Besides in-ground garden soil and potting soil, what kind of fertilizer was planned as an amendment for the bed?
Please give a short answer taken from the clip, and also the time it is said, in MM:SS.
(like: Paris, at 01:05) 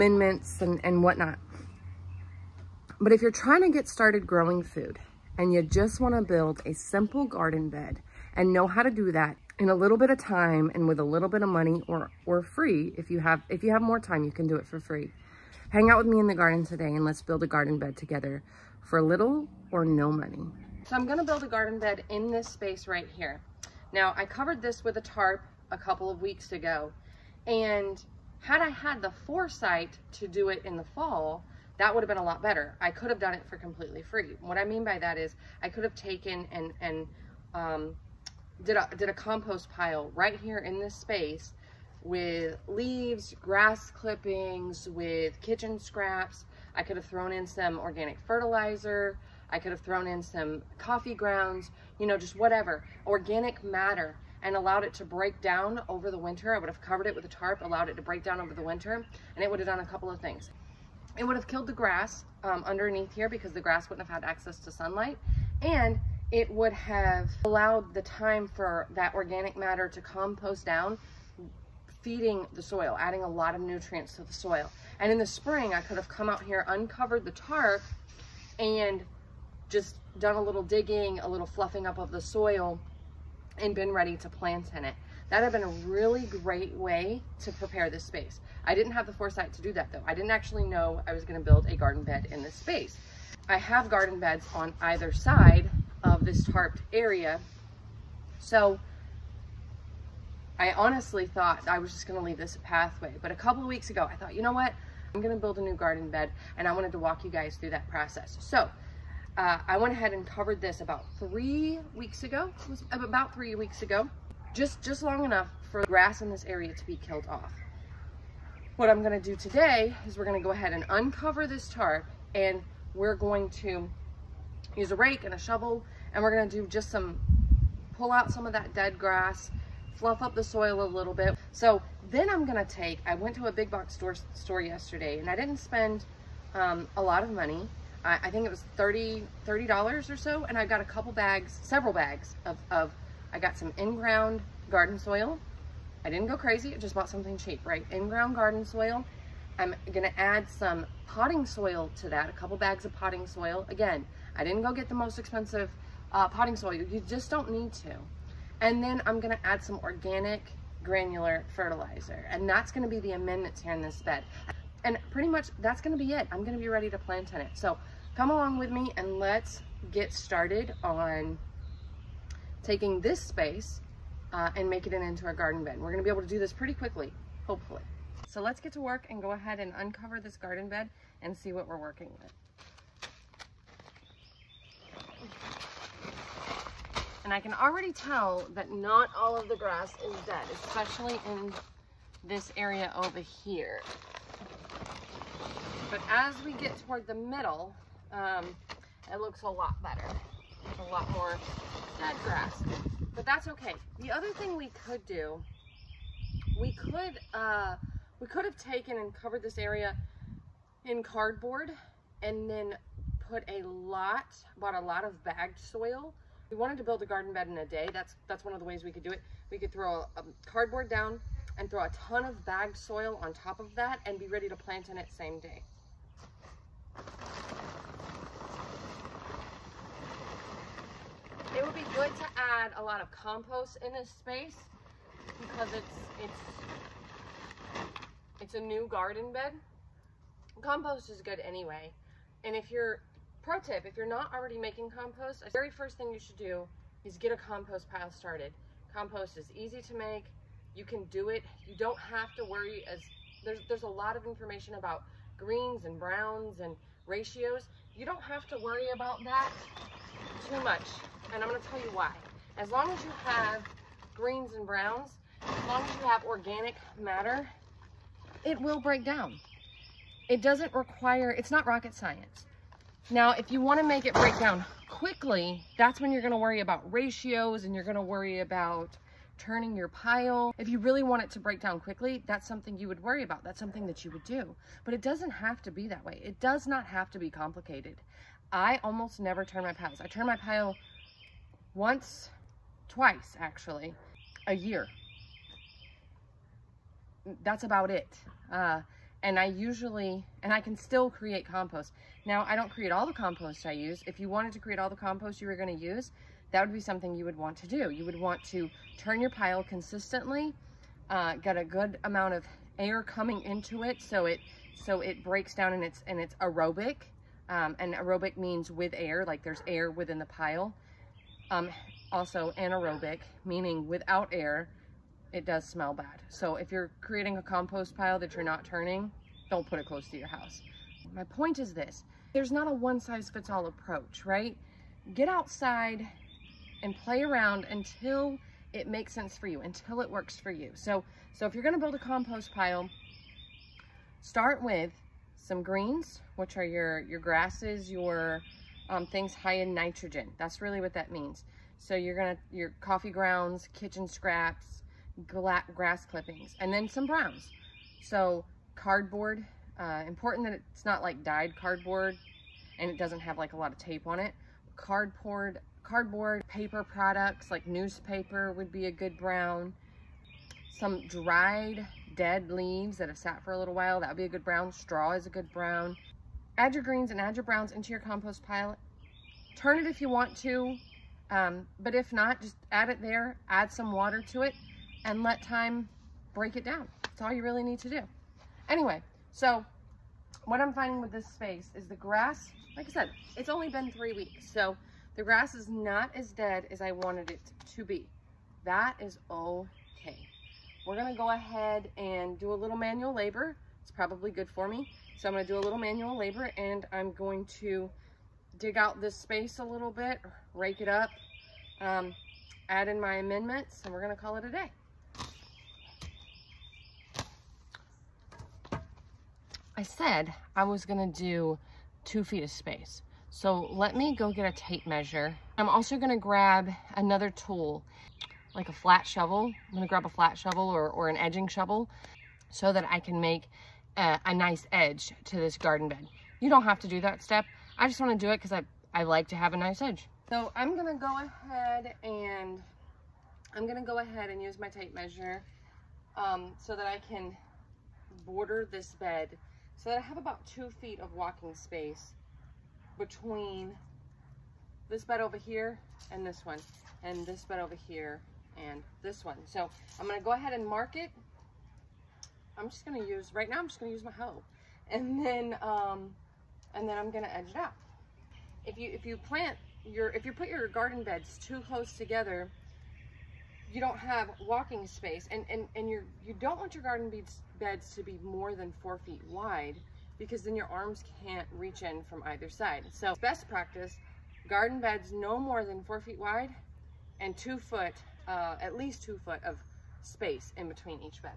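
Organic granular fertilizer, at 02:39.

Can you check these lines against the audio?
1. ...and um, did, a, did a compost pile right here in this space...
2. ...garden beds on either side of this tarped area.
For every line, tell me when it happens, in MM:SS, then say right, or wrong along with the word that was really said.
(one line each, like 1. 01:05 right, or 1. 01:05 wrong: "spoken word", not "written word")
1. 00:36 right
2. 01:33 right.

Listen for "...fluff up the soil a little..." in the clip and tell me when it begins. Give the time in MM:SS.
02:09.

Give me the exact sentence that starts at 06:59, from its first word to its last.
I said I was gonna do two feet of space.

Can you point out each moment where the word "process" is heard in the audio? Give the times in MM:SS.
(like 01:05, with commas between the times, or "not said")
01:47.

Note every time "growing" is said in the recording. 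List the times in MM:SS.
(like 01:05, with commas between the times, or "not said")
00:04.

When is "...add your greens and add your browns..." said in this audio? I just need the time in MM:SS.
06:16.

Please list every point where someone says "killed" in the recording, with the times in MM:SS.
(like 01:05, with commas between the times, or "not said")
01:01, 01:56.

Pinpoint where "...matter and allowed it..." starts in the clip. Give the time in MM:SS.
00:53.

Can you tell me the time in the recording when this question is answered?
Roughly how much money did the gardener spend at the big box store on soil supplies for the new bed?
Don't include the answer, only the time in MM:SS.
02:18.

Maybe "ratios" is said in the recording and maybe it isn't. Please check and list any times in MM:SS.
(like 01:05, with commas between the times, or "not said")
04:17, 04:36.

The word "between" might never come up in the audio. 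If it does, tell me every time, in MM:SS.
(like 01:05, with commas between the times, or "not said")
07:32, 08:10.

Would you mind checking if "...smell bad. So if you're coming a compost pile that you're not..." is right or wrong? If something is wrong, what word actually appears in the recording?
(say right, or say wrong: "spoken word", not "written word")
wrong: "creating", not "coming".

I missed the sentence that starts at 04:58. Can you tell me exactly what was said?
Uh, and I usually, and I can still create compost.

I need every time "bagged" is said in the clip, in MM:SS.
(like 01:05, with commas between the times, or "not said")
03:35, 03:42.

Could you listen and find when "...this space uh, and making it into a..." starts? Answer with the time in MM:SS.
02:53.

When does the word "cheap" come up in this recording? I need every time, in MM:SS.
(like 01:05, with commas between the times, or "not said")
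02:27.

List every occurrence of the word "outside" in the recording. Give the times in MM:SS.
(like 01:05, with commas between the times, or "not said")
05:35.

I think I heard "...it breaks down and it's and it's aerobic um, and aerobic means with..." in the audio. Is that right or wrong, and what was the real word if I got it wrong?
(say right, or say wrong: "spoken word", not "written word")
right.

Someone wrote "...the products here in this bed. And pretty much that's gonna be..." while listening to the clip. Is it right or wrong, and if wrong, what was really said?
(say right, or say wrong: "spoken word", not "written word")
wrong: "amendments", not "products".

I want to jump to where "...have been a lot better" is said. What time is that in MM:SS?
00:32.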